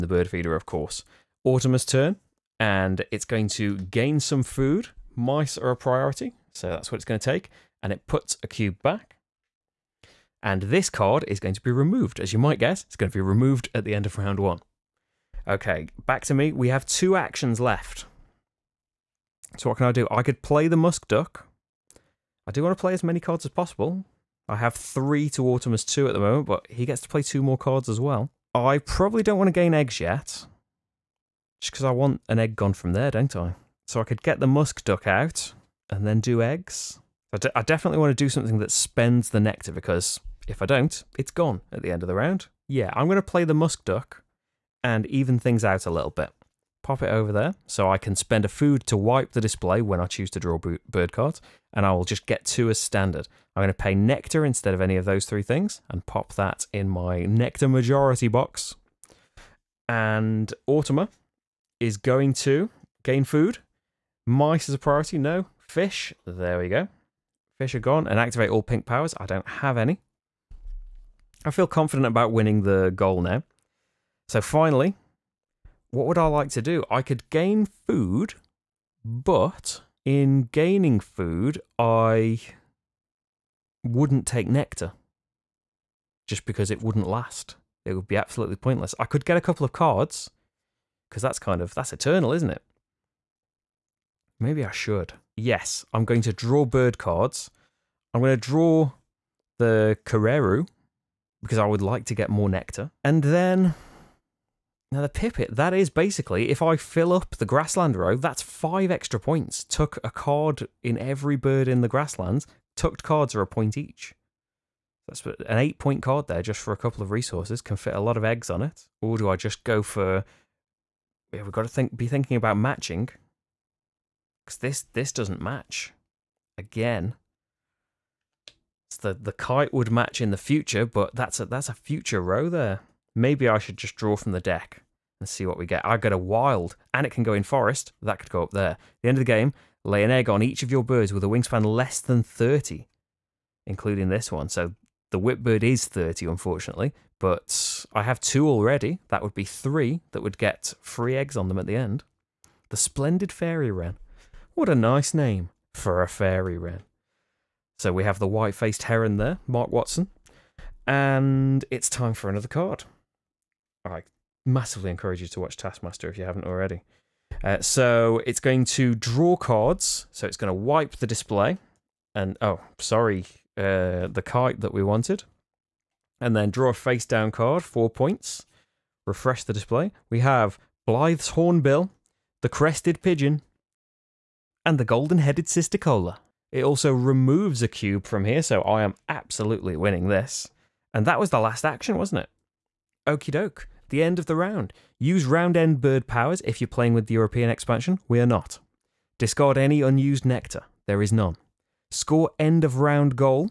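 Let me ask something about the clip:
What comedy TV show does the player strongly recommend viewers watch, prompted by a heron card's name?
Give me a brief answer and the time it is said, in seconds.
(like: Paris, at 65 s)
Taskmaster, at 165 s.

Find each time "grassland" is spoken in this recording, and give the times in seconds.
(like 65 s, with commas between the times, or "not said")
107 s, 111 s.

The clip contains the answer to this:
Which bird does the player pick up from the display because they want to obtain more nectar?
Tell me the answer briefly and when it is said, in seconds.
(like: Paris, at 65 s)
Kererū, at 100 s.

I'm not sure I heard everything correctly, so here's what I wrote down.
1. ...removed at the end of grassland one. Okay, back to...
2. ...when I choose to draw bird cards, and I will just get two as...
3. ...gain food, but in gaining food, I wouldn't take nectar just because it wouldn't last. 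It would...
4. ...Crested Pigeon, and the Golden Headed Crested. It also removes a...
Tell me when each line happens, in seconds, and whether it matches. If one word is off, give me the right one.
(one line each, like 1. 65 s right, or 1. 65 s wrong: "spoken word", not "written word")
1. 13 s wrong: "round", not "grassland"
2. 49 s right
3. 77 s right
4. 182 s wrong: "Cisticola", not "Crested".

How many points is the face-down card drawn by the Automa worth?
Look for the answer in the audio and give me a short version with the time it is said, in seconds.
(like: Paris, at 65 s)
4, at 177 s.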